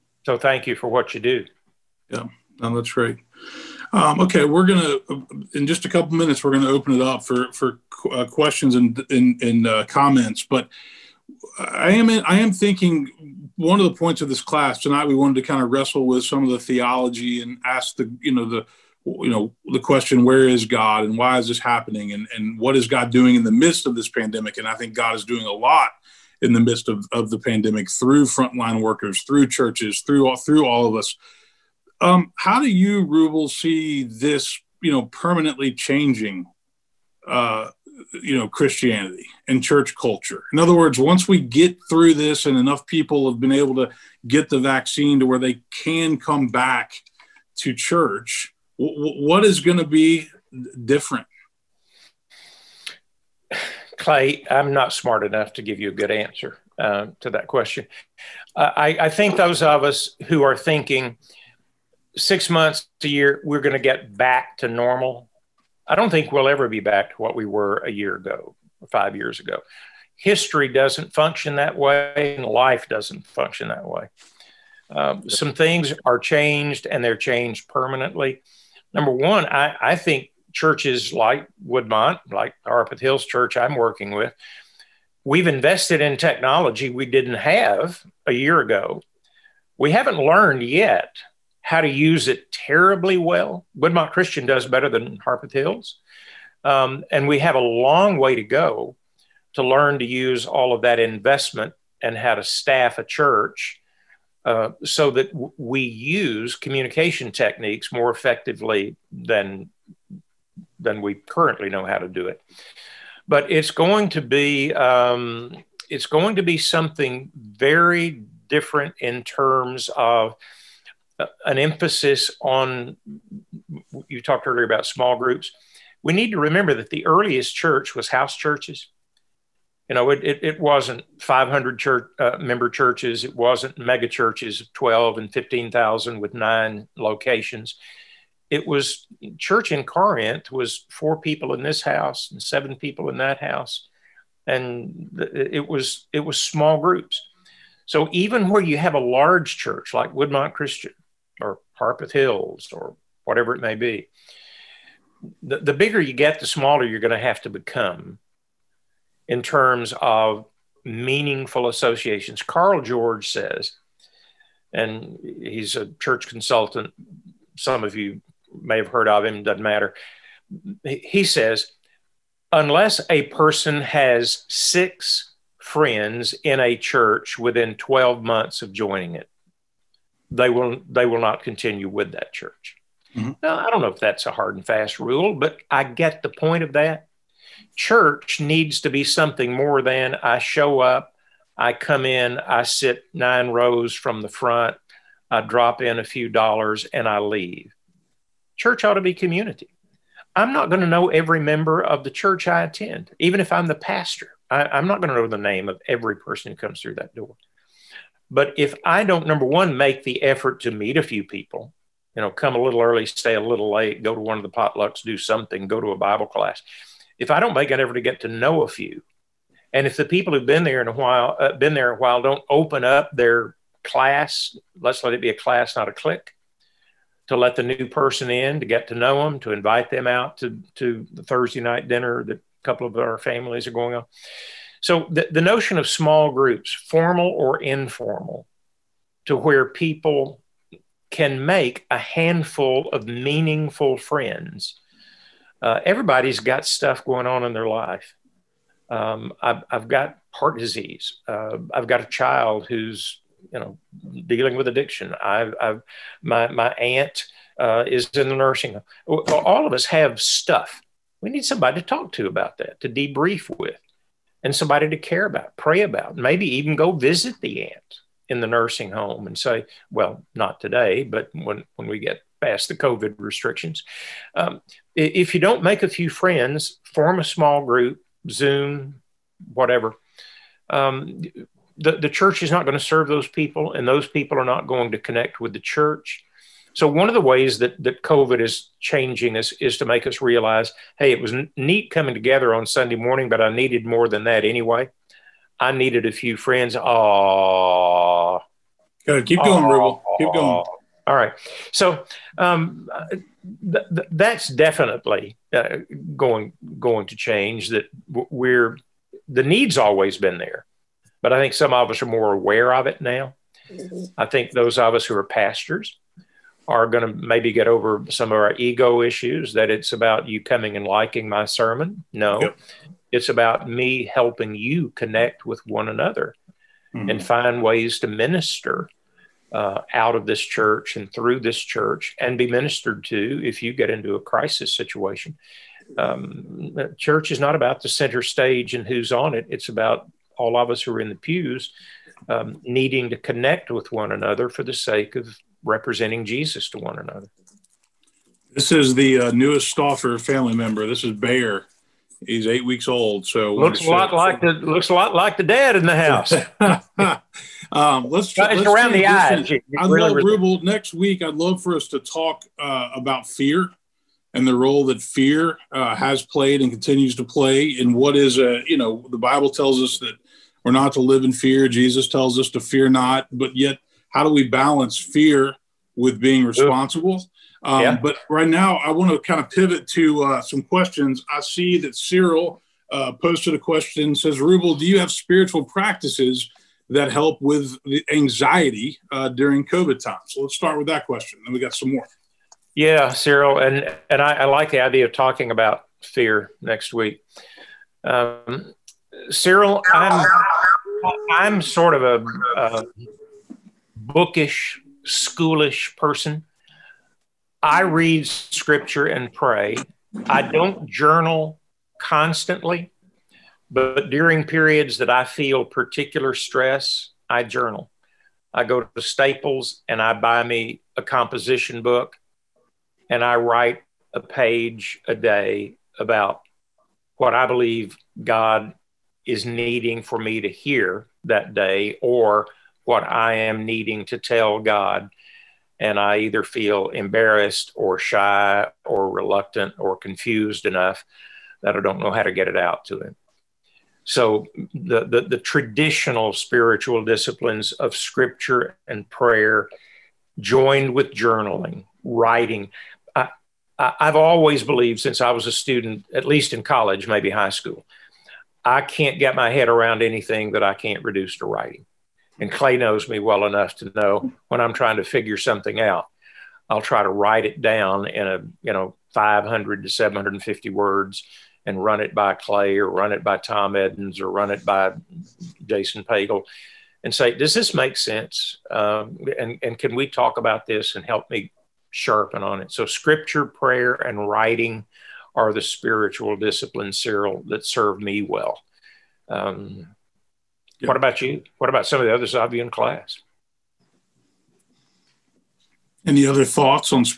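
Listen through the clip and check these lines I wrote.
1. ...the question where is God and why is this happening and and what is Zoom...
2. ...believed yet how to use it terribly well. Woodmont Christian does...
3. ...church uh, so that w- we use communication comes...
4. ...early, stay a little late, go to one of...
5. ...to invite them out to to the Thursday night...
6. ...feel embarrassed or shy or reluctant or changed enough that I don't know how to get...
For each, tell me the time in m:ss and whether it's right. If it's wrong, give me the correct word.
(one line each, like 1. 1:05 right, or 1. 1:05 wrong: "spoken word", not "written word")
1. 0:19 wrong: "God", not "Zoom"
2. 1:30 wrong: "learned", not "believed"
3. 1:43 wrong: "techniques", not "comes"
4. 3:32 right
5. 3:49 right
6. 7:16 wrong: "confused", not "changed".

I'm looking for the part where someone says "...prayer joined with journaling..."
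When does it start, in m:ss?
7:29.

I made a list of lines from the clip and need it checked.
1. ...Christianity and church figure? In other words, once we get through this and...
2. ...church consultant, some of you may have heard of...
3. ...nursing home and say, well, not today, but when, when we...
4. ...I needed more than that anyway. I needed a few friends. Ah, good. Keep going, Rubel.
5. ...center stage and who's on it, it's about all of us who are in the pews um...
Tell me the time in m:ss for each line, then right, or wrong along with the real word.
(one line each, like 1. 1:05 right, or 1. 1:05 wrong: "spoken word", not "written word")
1. 0:38 wrong: "culture", not "figure"
2. 2:46 right
3. 4:28 right
4. 4:53 right
5. 5:37 right.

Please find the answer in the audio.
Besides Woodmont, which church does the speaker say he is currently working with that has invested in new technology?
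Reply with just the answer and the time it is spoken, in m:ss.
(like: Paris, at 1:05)
Harpeth Hills Church, at 1:22.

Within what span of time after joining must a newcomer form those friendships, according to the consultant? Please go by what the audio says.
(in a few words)
12 months.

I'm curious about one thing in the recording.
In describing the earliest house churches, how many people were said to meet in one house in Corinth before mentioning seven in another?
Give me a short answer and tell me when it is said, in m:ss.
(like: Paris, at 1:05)
4, at 2:20.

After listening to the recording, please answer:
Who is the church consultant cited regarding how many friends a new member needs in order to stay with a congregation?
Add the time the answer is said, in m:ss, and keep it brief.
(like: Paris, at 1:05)
Carl George, at 2:42.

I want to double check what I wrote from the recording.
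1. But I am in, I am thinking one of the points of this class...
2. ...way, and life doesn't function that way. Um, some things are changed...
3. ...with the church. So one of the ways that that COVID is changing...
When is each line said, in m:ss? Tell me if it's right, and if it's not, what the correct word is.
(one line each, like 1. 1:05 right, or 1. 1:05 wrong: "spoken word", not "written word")
1. 0:10 right
2. 1:11 right
3. 4:45 right.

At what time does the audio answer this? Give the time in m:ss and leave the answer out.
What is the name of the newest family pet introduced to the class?
5:51.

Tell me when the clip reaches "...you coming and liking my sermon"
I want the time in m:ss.
5:20.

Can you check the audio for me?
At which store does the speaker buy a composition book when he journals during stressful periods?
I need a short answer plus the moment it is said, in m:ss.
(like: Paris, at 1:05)
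Staples, at 6:59.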